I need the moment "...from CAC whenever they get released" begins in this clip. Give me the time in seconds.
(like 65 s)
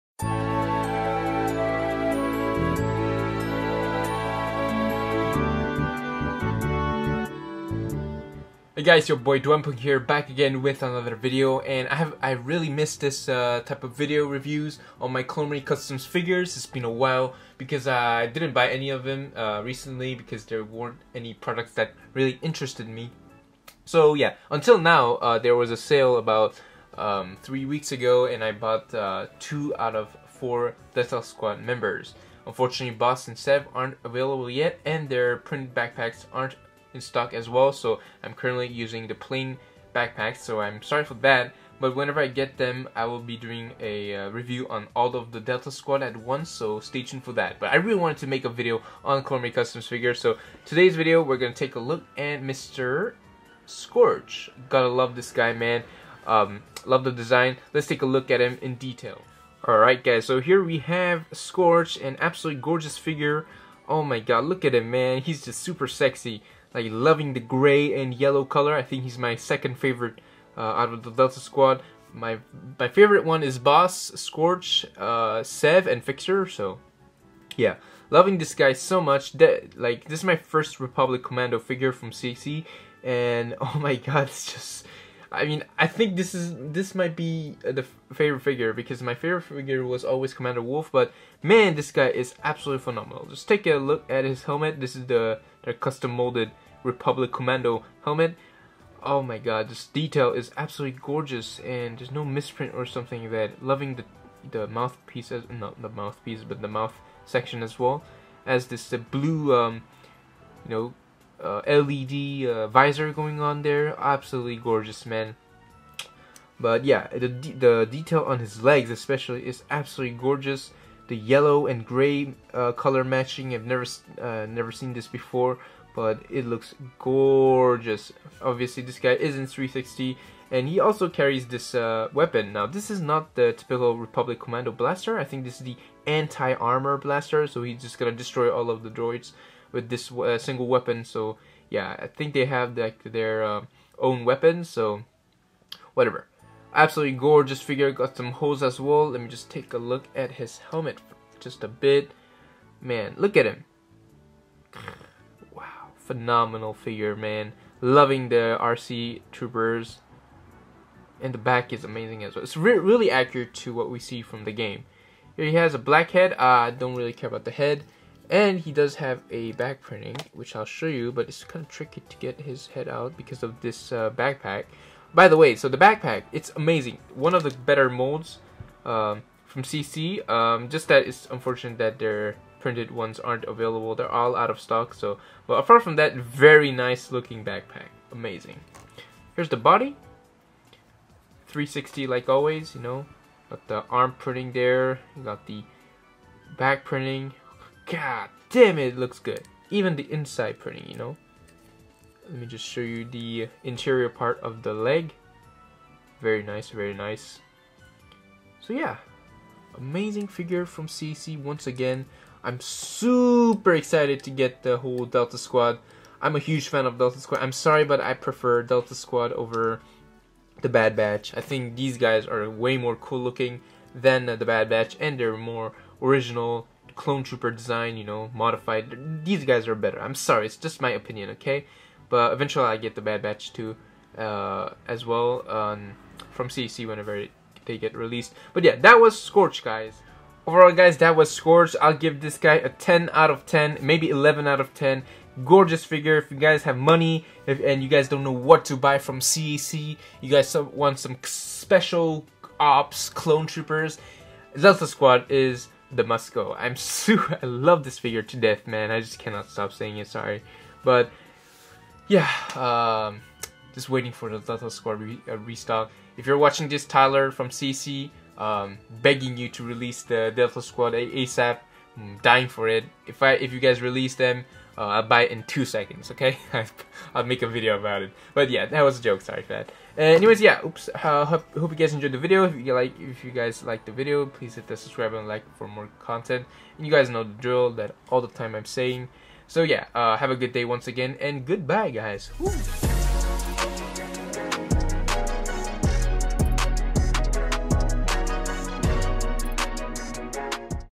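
236 s.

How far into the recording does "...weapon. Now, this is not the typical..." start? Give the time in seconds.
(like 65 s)
132 s.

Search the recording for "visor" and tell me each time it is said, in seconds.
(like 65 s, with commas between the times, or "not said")
112 s.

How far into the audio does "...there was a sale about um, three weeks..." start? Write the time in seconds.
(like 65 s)
25 s.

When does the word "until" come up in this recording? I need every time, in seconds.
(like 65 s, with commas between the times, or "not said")
24 s.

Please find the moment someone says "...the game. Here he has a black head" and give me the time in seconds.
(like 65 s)
164 s.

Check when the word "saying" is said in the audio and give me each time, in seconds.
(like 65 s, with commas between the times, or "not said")
259 s, 288 s.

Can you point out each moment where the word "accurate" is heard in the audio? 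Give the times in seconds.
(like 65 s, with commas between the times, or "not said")
163 s.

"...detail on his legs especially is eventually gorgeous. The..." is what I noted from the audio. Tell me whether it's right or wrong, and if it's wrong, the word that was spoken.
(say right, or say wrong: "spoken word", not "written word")
wrong: "absolutely", not "eventually".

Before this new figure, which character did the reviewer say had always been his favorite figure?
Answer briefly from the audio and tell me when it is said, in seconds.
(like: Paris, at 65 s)
Commander Wolf, at 90 s.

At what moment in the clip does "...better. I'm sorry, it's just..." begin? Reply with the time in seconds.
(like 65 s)
229 s.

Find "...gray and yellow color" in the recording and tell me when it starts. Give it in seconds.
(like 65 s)
67 s.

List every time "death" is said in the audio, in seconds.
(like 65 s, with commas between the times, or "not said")
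258 s.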